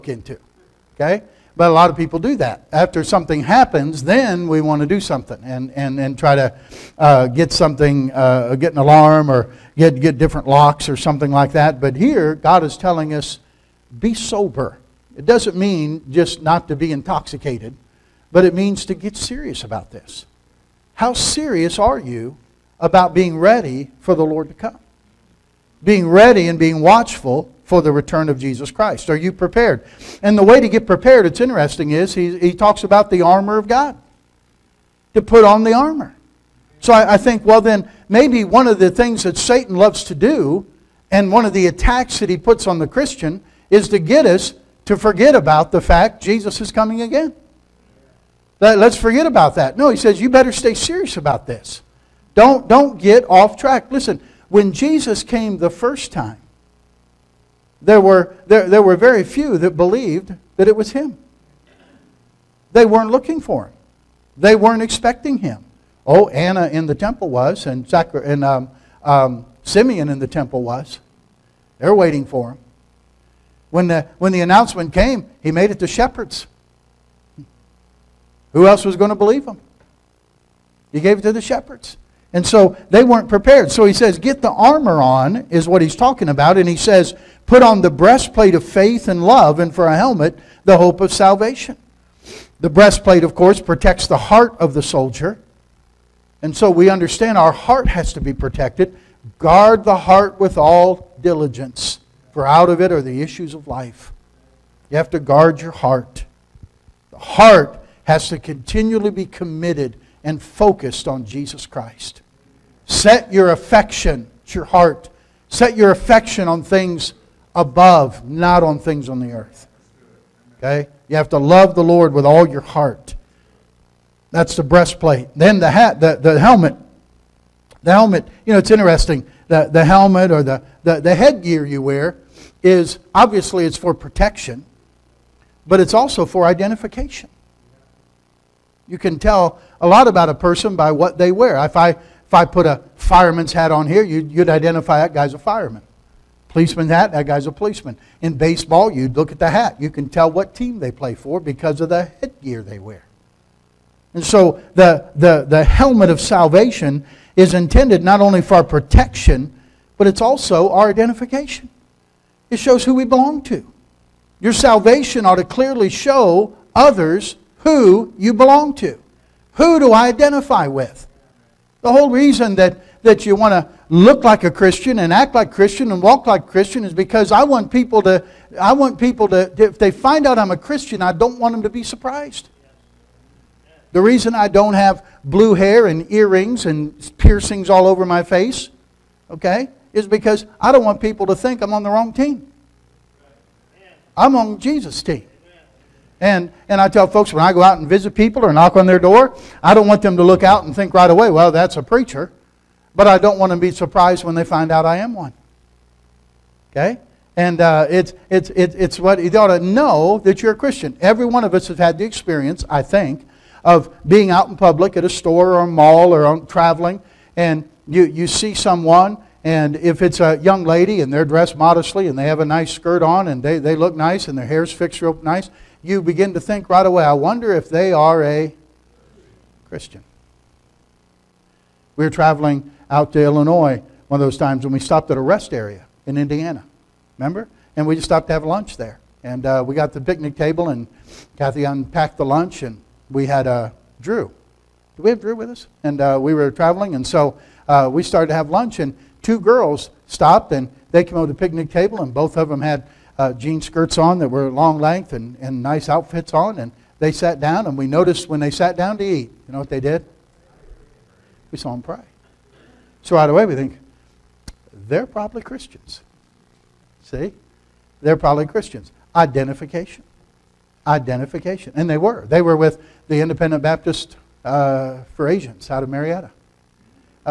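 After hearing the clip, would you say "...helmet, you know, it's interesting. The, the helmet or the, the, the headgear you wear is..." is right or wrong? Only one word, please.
right.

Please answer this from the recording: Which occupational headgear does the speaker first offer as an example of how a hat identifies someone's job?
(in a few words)
Fireman's hat.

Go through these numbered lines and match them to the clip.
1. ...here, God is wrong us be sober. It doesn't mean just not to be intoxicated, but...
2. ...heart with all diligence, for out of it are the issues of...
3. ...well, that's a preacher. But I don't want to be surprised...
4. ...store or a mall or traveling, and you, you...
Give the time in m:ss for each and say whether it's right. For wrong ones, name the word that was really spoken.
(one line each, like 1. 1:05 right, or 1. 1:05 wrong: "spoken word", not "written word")
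1. 0:11 wrong: "telling", not "wrong"
2. 1:39 right
3. 3:21 right
4. 3:35 right.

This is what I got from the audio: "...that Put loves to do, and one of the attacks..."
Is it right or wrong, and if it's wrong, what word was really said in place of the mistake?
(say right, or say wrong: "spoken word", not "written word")
wrong: "Satan", not "Put".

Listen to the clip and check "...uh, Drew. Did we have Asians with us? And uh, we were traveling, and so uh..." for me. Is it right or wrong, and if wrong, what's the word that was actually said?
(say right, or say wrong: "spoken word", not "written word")
wrong: "Drew", not "Asians".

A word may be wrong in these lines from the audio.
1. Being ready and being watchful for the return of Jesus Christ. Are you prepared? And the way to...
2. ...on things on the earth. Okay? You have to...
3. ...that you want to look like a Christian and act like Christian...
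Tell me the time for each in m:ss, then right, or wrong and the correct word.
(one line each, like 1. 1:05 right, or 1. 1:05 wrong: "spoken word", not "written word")
1. 0:25 right
2. 1:58 right
3. 2:53 right.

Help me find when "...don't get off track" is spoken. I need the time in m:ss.
0:52.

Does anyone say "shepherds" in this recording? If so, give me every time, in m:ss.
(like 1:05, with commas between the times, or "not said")
1:15, 1:21.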